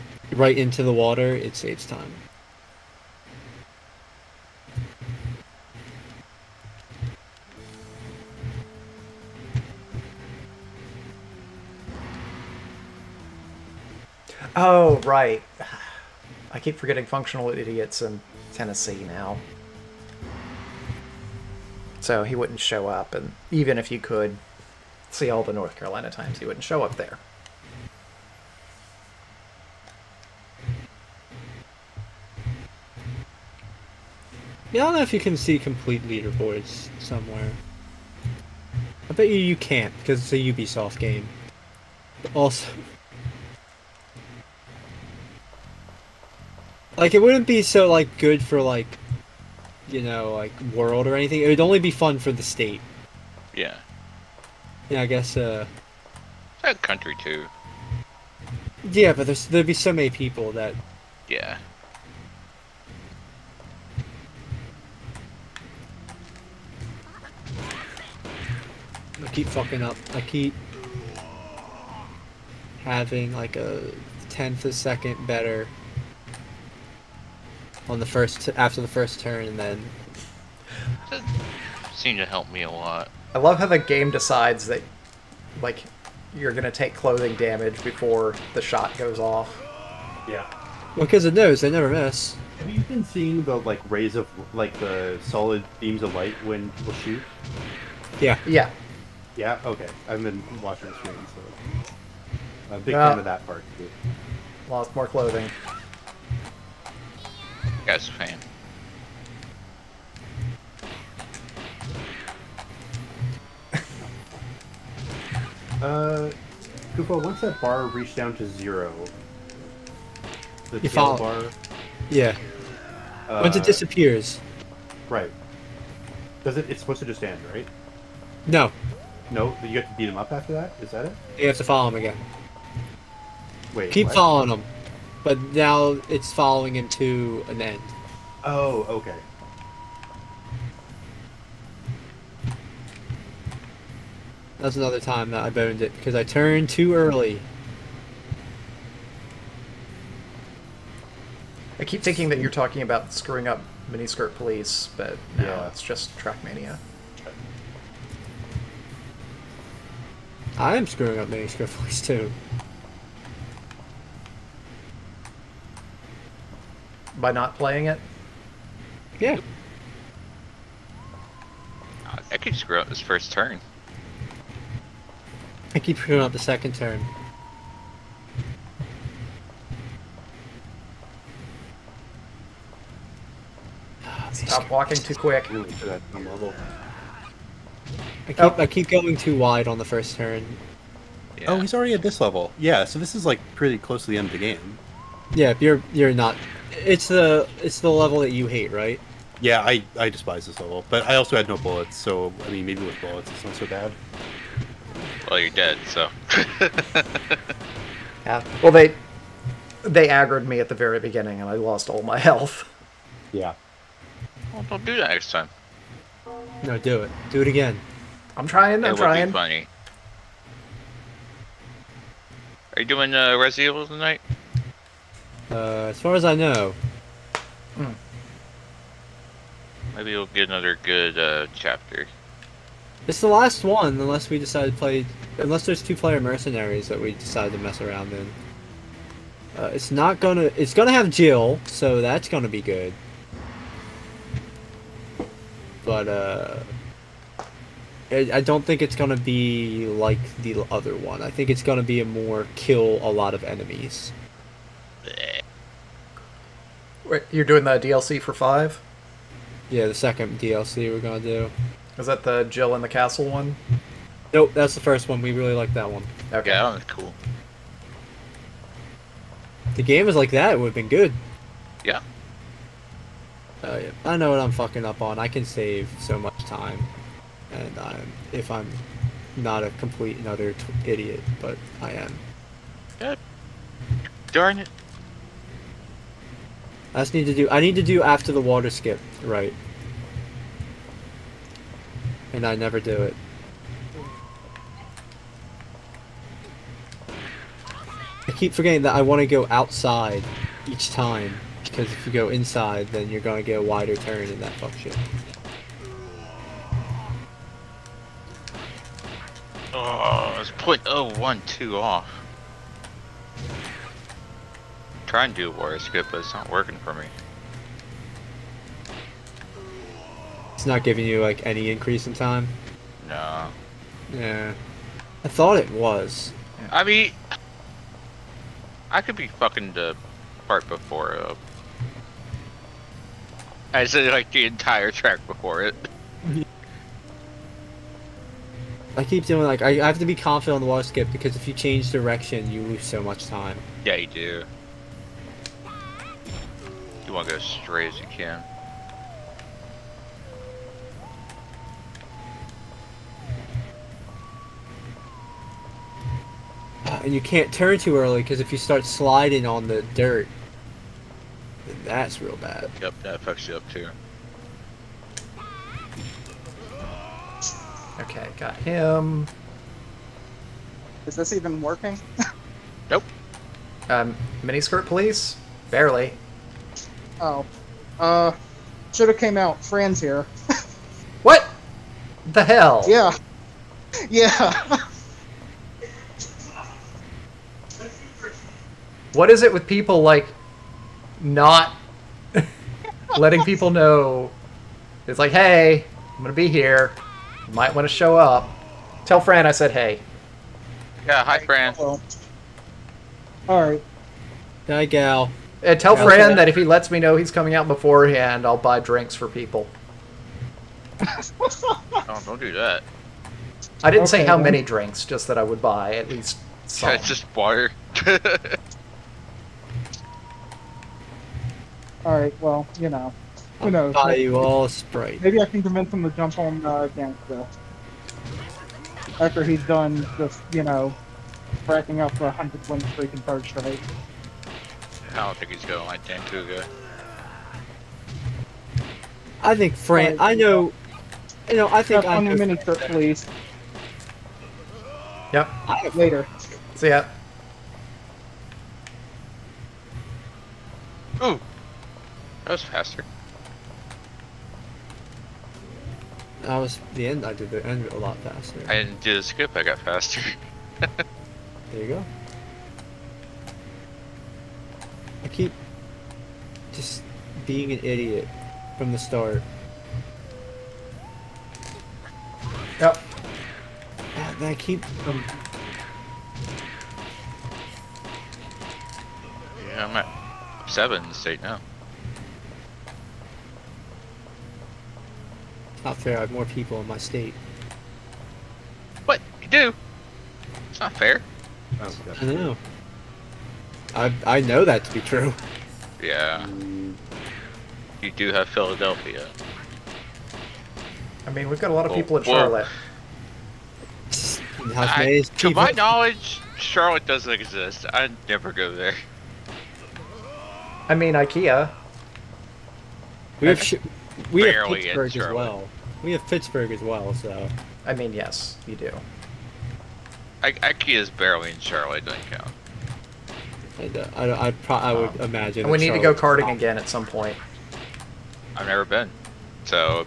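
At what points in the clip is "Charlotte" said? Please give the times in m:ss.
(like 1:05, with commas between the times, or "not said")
8:22, 8:26, 8:41, 8:45.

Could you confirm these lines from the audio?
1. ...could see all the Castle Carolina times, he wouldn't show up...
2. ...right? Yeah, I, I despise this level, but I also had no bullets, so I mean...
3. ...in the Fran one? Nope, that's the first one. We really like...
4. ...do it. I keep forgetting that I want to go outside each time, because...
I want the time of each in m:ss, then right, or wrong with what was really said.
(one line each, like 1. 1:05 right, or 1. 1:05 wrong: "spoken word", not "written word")
1. 0:23 wrong: "North", not "Castle"
2. 3:18 right
3. 4:22 wrong: "Castle", not "Fran"
4. 4:52 right.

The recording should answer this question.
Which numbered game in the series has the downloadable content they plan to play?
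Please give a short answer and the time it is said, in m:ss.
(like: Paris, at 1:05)
Resident Evil 5, at 4:18.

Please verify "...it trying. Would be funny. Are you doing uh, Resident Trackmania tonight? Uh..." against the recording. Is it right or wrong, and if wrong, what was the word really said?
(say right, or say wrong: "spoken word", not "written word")
wrong: "Evil", not "Trackmania".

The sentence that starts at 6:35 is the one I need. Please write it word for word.
It's like, hey, I'm gonna be here.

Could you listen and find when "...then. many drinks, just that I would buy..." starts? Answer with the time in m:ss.
6:54.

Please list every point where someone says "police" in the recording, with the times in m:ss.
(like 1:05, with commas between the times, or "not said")
2:34, 2:41, 6:14.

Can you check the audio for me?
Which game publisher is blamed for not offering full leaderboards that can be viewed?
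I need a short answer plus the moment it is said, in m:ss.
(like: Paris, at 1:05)
Ubisoft, at 0:40.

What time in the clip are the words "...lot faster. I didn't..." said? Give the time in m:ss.
7:37.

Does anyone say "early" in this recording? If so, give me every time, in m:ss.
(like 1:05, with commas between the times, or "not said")
2:26, 5:57.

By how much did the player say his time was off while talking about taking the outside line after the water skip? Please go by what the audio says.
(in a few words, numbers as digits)
.012.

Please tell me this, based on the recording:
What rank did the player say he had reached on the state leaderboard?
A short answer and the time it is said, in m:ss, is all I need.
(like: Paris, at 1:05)
7, at 8:00.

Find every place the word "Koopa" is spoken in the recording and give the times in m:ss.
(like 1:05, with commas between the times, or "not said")
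1:56.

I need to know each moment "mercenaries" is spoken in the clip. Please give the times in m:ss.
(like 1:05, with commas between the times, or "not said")
3:56.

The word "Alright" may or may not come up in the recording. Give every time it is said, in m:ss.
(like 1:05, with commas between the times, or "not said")
6:43, 7:02.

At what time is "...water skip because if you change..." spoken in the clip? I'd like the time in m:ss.
5:40.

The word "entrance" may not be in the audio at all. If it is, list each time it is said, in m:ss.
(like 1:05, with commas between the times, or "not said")
not said.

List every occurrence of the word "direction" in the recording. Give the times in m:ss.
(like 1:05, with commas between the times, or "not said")
5:41.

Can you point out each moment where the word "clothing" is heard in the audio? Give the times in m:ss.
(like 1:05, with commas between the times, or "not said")
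1:26, 1:45.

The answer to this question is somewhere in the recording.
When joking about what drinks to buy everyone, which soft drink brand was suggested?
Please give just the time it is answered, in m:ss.
7:04.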